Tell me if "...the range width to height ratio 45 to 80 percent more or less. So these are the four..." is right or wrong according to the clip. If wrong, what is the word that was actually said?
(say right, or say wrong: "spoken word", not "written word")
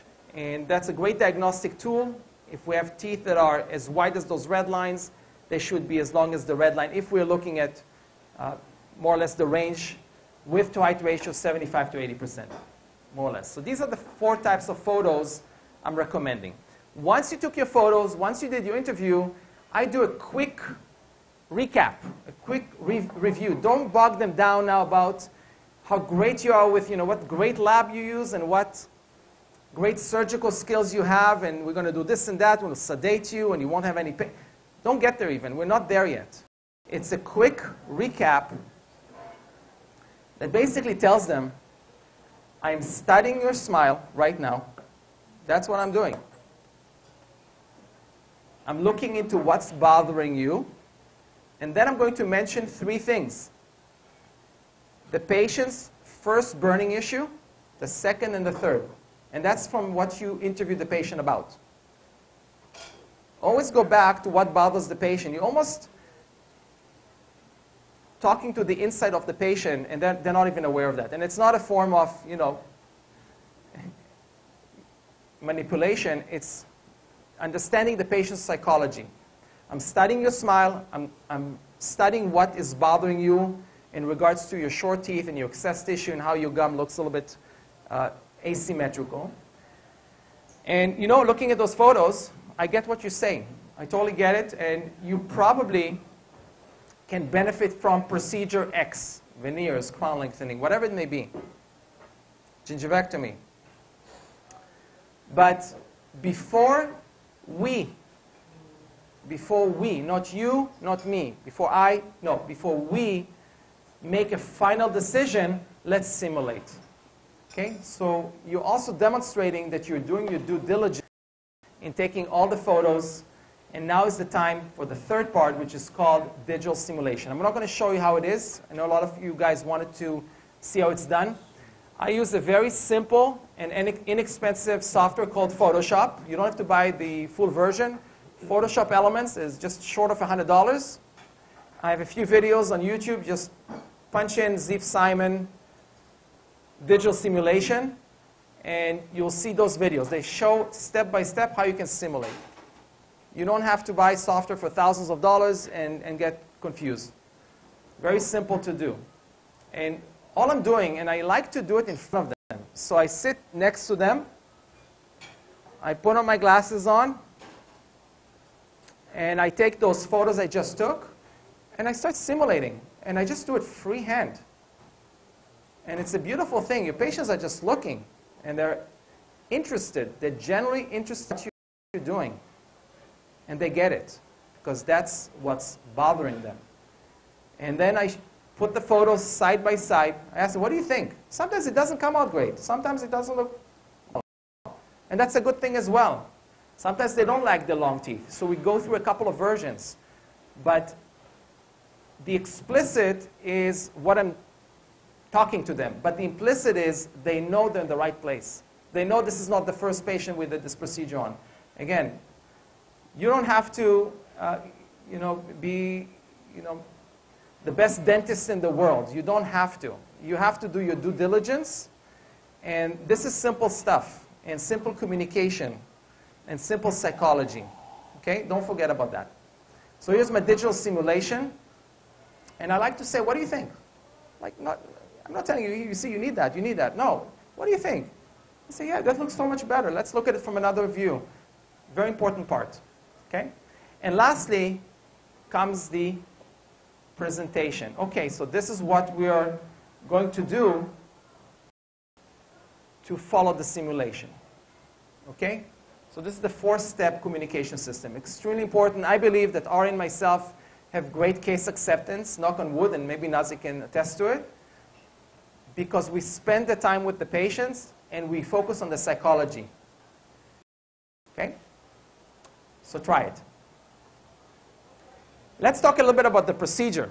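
wrong: "75", not "45".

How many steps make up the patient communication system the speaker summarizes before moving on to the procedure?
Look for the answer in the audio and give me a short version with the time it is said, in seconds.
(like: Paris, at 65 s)
4, at 256 s.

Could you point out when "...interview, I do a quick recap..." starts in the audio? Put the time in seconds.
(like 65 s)
18 s.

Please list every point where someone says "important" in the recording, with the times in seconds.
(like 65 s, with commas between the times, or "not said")
242 s, 258 s.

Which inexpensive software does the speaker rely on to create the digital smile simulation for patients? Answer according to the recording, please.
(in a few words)
Photoshop Elements.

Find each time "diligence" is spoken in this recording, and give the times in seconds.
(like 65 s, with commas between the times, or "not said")
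120 s, 221 s.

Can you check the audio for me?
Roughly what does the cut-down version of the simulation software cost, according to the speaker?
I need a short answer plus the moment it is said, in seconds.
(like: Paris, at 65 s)
just short of $100, at 139 s.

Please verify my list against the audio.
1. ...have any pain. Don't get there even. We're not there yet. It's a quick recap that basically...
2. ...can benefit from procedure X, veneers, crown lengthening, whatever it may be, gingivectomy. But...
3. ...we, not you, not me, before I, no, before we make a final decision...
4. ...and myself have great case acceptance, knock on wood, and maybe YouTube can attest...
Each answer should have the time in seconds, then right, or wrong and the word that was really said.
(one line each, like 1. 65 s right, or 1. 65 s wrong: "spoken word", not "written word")
1. 33 s right
2. 97 s right
3. 109 s right
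4. 259 s wrong: "Nazi", not "YouTube".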